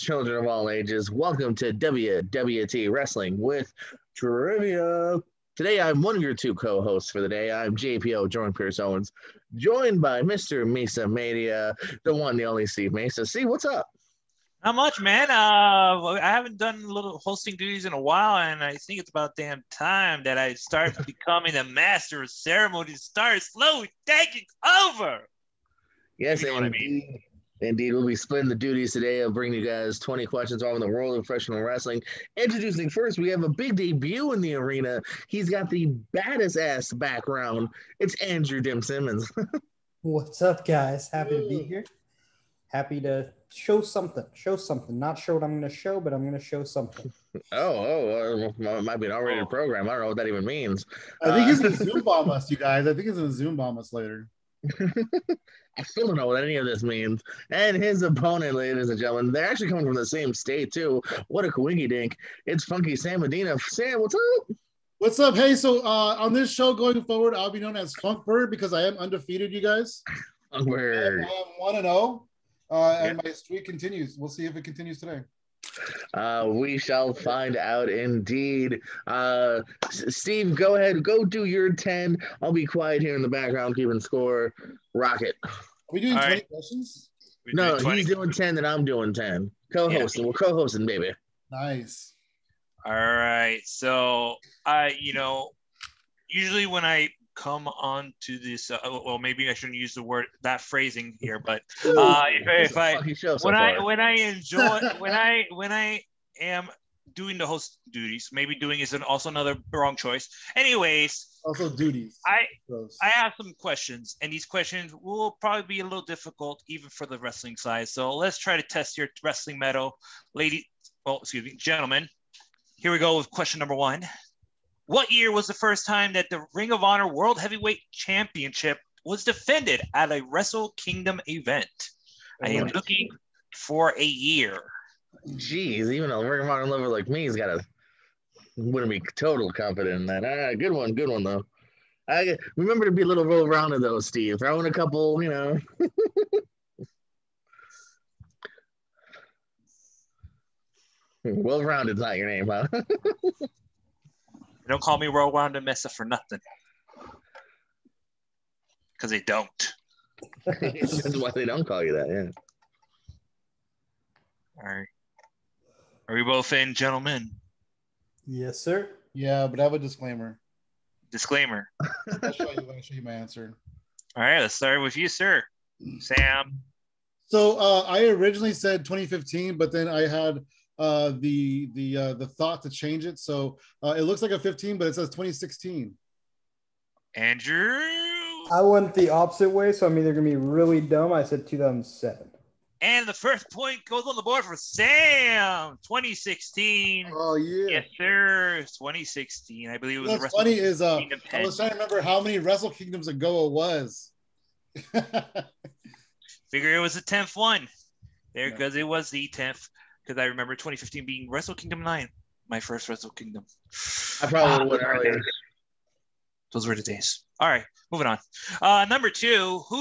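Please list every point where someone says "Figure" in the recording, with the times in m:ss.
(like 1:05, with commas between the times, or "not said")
3:26.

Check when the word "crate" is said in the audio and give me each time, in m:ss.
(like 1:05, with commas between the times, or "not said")
not said.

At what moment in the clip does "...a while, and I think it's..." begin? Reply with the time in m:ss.
0:17.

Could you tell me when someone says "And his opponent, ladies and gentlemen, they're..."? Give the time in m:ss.
0:57.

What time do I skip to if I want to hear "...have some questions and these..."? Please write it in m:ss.
1:53.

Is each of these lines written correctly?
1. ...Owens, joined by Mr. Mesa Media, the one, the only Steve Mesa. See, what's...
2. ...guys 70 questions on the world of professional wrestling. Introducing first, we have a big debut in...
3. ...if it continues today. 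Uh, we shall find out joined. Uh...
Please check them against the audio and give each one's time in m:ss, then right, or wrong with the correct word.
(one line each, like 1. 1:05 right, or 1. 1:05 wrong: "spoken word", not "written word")
1. 0:08 right
2. 0:29 wrong: "20", not "70"
3. 1:14 wrong: "indeed", not "joined".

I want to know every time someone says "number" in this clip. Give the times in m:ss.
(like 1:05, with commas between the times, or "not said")
2:03, 3:38.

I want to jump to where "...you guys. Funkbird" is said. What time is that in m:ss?
1:09.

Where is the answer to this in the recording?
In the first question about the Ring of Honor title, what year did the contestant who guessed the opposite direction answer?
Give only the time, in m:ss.
3:11.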